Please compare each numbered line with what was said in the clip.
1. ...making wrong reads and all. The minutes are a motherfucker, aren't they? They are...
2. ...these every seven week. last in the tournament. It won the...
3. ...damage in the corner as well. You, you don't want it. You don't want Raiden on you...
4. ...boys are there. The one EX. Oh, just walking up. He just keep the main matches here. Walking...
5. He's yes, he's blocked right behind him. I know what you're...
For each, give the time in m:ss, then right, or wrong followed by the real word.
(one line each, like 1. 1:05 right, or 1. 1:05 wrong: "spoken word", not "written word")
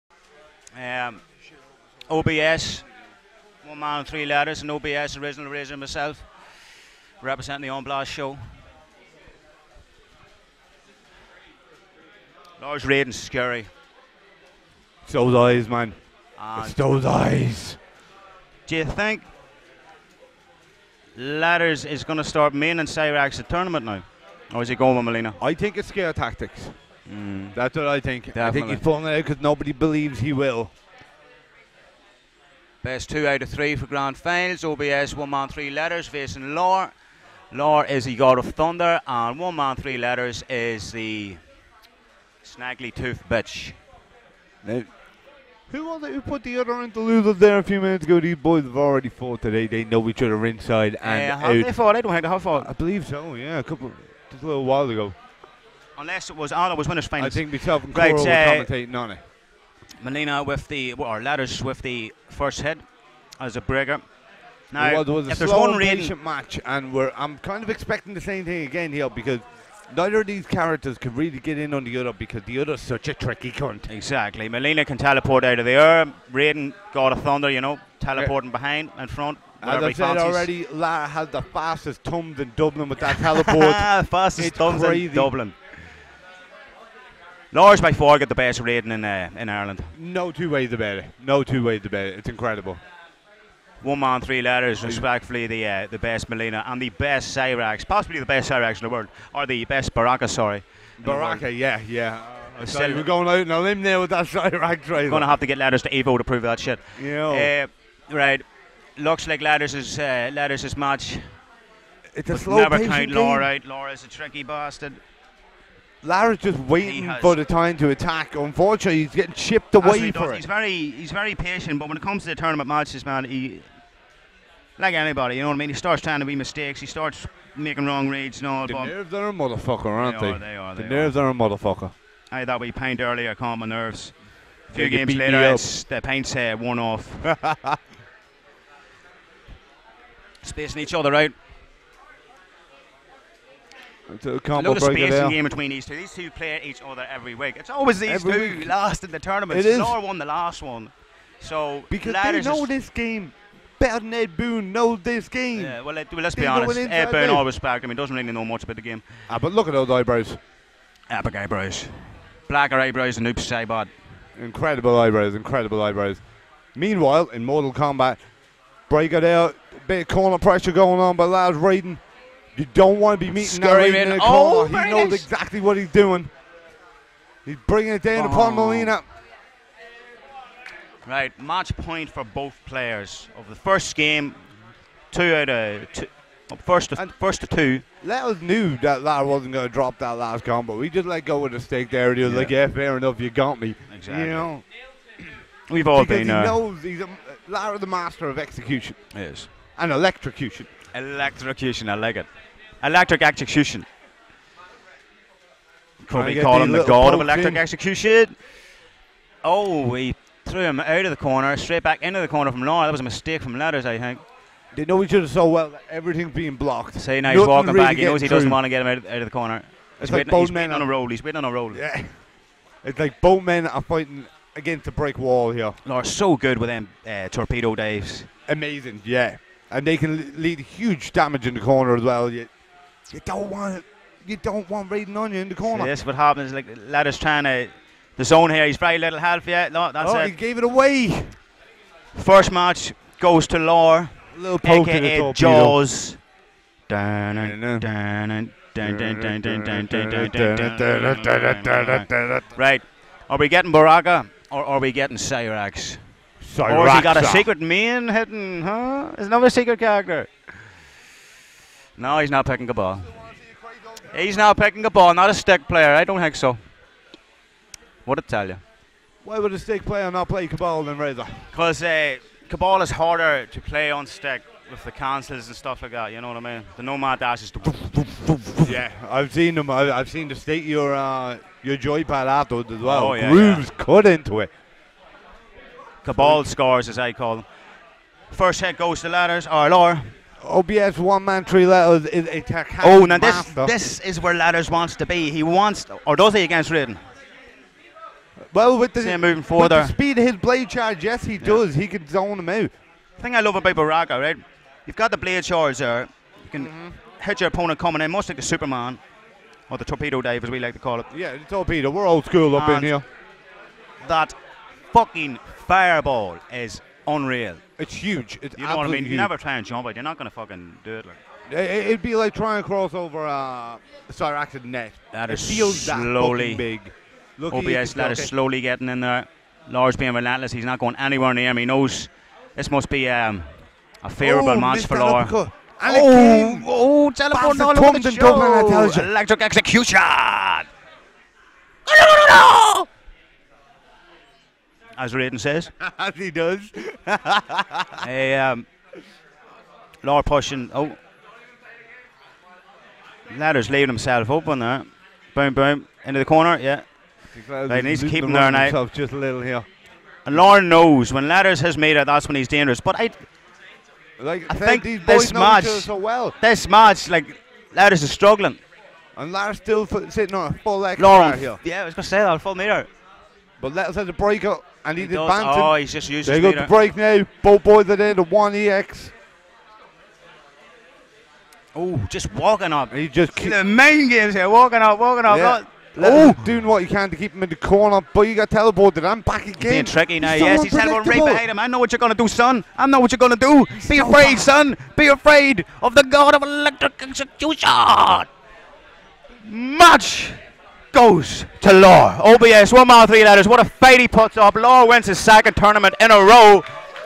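1. 2:07 wrong: "nerves", not "minutes"
2. 2:27 wrong: "two", not "seven"
3. 3:51 right
4. 6:17 wrong: "games", not "matches"
5. 6:30 wrong: "teleported", not "blocked".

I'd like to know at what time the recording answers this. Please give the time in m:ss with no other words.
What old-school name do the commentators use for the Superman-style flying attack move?
5:09.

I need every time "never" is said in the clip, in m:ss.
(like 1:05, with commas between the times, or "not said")
1:52, 5:19.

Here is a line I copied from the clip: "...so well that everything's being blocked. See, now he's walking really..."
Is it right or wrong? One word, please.
right.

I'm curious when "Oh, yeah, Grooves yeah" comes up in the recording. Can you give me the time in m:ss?
4:43.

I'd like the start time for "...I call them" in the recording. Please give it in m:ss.
4:46.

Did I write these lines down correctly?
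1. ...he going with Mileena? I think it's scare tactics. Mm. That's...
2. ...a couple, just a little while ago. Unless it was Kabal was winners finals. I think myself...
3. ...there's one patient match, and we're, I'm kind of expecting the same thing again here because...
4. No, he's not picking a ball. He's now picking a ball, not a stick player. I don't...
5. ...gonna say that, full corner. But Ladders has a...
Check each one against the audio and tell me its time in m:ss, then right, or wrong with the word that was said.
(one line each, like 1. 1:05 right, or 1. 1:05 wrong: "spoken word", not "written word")
1. 0:24 right
2. 0:53 wrong: "Arlo", not "Kabal"
3. 1:05 right
4. 4:21 right
5. 6:11 wrong: "meter", not "corner".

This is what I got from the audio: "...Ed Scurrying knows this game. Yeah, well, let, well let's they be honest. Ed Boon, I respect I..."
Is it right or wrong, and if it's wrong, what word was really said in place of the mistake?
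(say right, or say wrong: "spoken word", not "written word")
wrong: "Boon", not "Scurrying".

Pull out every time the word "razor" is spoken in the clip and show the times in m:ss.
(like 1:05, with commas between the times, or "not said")
0:05, 4:30.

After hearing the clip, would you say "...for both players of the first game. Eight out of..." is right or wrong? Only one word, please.
wrong.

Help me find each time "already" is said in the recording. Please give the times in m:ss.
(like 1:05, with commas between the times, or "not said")
0:48, 1:20.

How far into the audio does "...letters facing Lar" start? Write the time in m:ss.
0:35.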